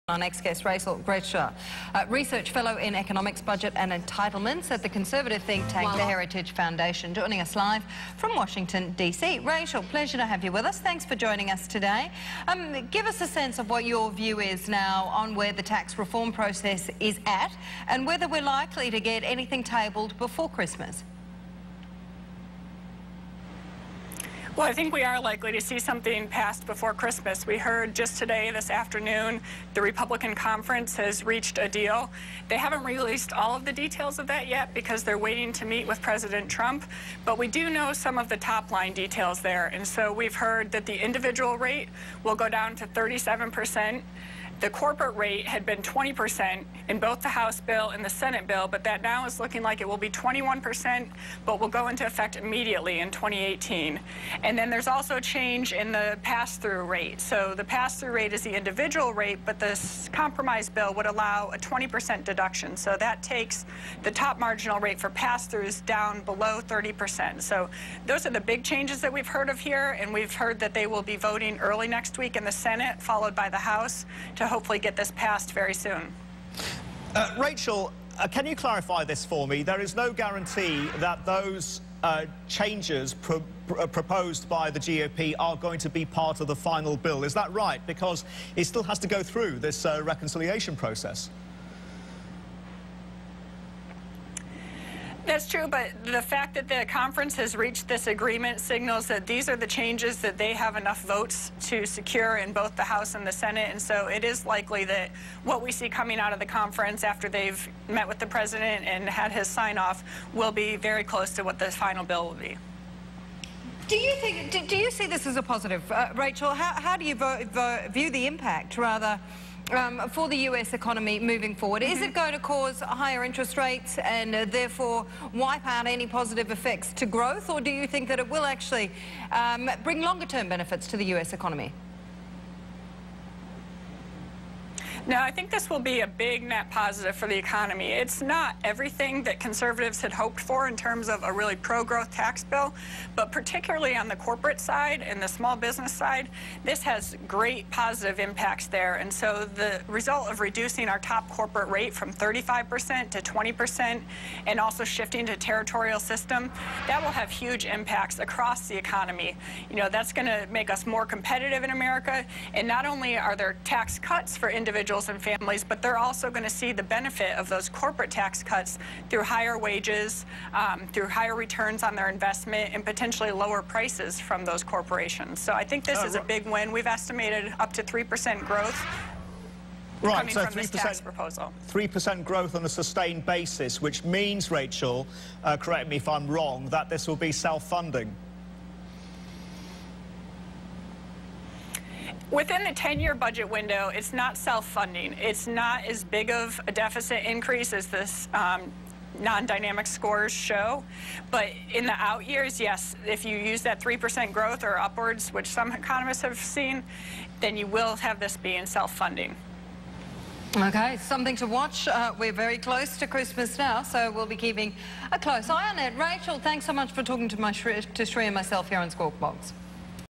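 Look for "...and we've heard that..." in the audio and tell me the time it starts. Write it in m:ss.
1:09.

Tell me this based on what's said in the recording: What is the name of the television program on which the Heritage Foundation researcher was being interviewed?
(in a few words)
Squawk Box.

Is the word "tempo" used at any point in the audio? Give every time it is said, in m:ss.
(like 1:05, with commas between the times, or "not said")
not said.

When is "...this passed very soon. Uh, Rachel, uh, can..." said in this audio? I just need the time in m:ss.
1:14.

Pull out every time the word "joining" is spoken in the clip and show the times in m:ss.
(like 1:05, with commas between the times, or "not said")
0:07, 0:11.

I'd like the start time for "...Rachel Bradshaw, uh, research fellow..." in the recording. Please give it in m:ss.
0:00.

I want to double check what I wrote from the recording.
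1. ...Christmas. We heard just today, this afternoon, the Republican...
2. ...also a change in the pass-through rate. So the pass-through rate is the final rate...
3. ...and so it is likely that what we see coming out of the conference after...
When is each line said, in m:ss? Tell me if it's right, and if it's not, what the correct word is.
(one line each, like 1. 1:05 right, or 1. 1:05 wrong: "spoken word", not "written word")
1. 0:26 right
2. 0:54 wrong: "individual", not "final"
3. 1:43 right.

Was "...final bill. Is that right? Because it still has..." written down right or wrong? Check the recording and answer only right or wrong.
right.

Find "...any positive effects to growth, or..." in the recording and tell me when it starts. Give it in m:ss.
2:05.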